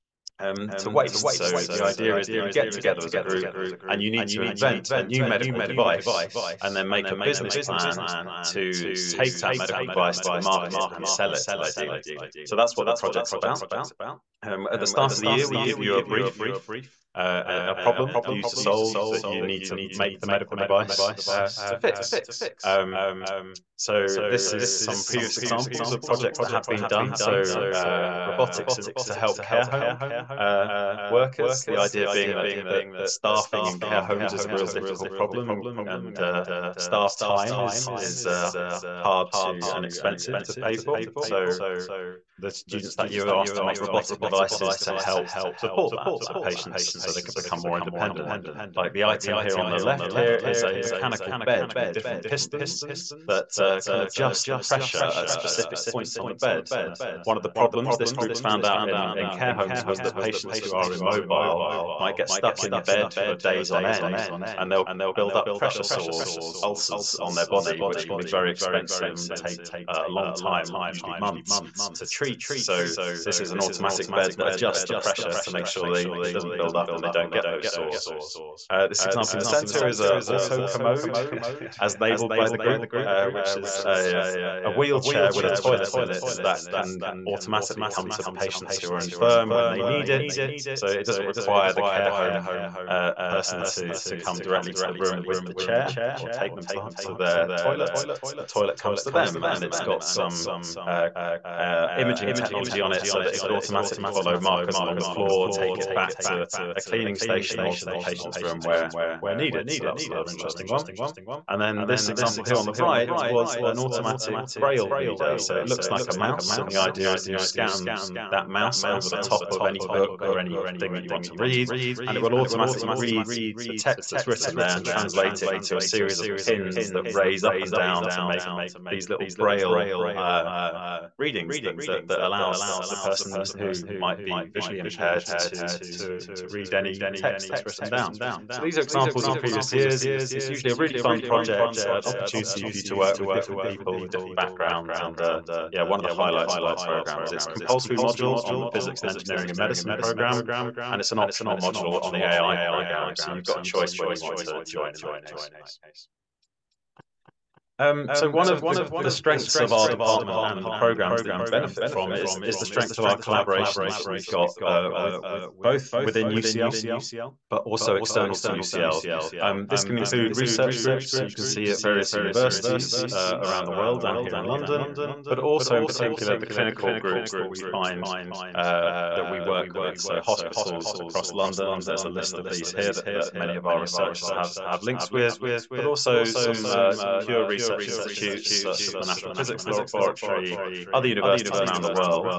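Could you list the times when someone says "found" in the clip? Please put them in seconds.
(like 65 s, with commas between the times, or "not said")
58 s.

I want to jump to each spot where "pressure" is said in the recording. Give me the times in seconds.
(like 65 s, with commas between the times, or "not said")
54 s, 65 s, 74 s.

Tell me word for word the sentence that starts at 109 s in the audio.
So that was another interesting one.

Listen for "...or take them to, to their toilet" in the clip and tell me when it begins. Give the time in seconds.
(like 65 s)
96 s.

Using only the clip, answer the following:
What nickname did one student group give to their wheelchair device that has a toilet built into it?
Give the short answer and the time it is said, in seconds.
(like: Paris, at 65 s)
auto commode, at 80 s.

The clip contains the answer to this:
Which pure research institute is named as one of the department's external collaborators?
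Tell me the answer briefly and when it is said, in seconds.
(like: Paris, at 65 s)
National Physics Laboratory, at 189 s.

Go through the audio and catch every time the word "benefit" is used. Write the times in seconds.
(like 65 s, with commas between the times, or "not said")
161 s.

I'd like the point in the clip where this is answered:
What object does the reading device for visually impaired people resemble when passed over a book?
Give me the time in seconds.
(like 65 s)
116 s.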